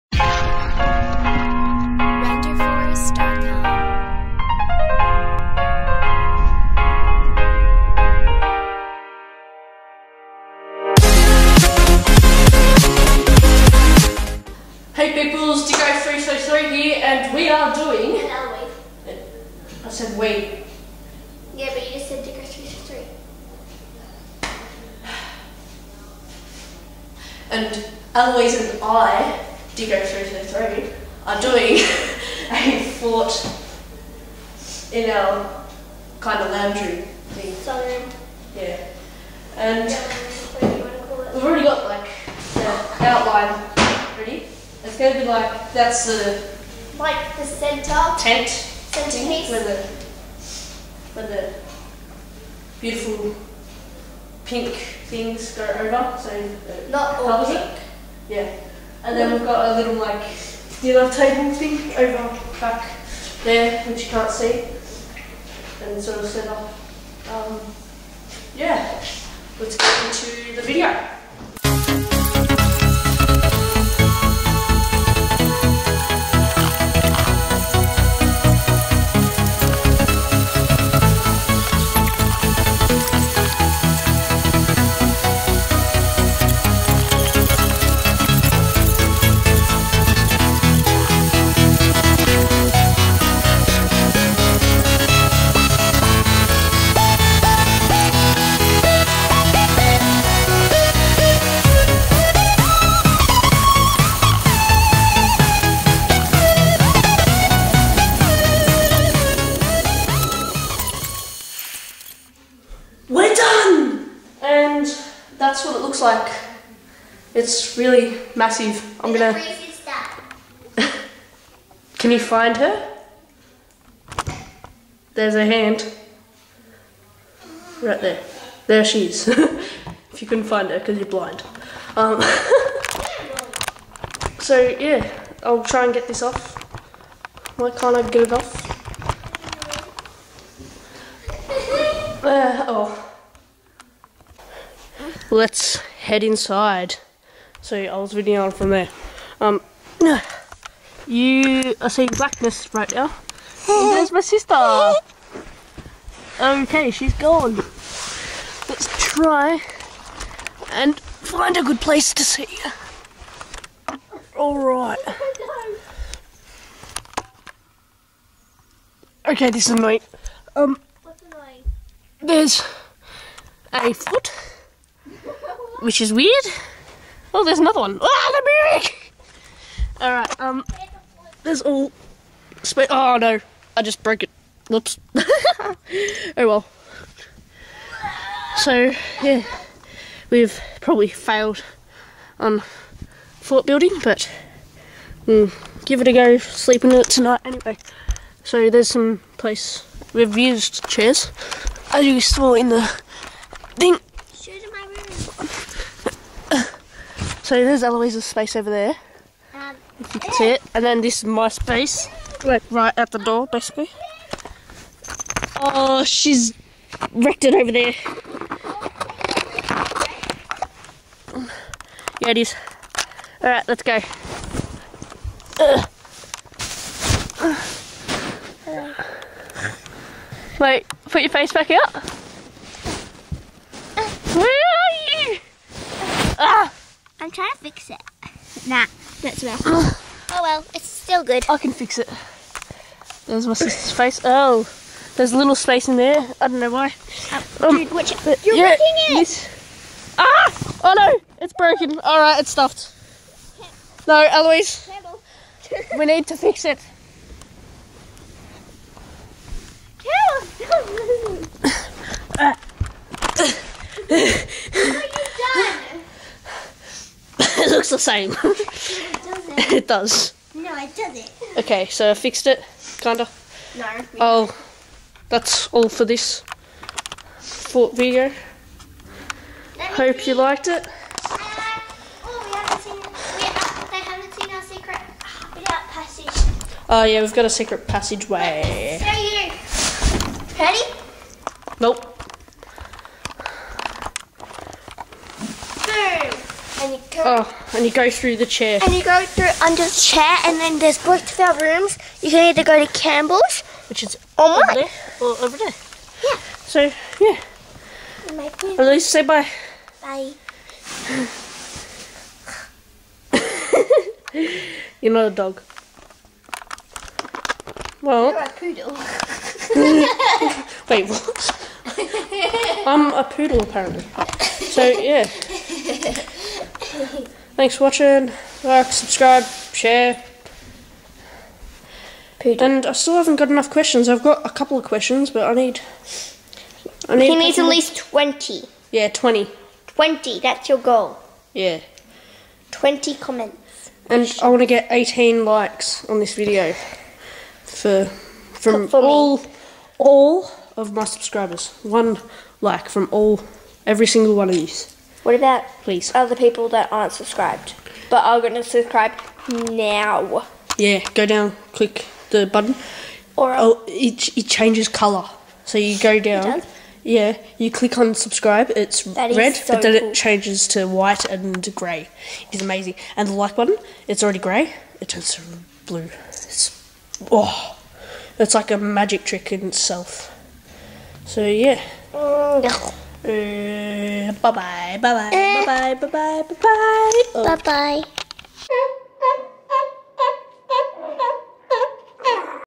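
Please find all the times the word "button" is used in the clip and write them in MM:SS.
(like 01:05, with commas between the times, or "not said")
06:02, 06:13.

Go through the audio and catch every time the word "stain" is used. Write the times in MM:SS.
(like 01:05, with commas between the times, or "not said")
not said.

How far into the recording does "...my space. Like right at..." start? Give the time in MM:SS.
03:31.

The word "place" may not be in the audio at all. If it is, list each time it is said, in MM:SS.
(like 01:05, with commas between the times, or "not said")
02:41, 03:19.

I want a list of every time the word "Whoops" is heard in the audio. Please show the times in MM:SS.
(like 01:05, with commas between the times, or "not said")
03:04.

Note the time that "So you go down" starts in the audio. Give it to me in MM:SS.
06:05.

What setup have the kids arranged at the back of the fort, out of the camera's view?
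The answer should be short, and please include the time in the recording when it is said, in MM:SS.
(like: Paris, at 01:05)
Dinner table, at 01:00.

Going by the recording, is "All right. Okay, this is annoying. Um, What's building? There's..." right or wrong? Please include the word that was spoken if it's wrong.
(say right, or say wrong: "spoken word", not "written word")
wrong: "annoying", not "building".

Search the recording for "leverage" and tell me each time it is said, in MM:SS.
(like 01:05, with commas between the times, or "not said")
not said.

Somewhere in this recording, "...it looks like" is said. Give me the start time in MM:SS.
01:55.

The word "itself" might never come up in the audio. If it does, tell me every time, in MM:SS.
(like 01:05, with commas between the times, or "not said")
06:19.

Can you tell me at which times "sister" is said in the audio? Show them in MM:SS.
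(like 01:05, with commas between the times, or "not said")
02:34, 04:03.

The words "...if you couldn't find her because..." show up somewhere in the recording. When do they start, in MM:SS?
02:09.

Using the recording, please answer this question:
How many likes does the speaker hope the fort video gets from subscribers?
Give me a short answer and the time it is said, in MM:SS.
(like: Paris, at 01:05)
18, at 05:44.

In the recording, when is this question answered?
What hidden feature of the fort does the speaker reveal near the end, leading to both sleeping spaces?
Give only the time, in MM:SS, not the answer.
04:47.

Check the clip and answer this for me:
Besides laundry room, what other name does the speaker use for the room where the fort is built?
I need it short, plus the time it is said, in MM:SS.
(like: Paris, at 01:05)
Sunroom, at 00:37.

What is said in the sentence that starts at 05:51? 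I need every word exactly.
One like from all every single one of these.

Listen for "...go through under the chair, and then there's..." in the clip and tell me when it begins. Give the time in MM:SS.
04:59.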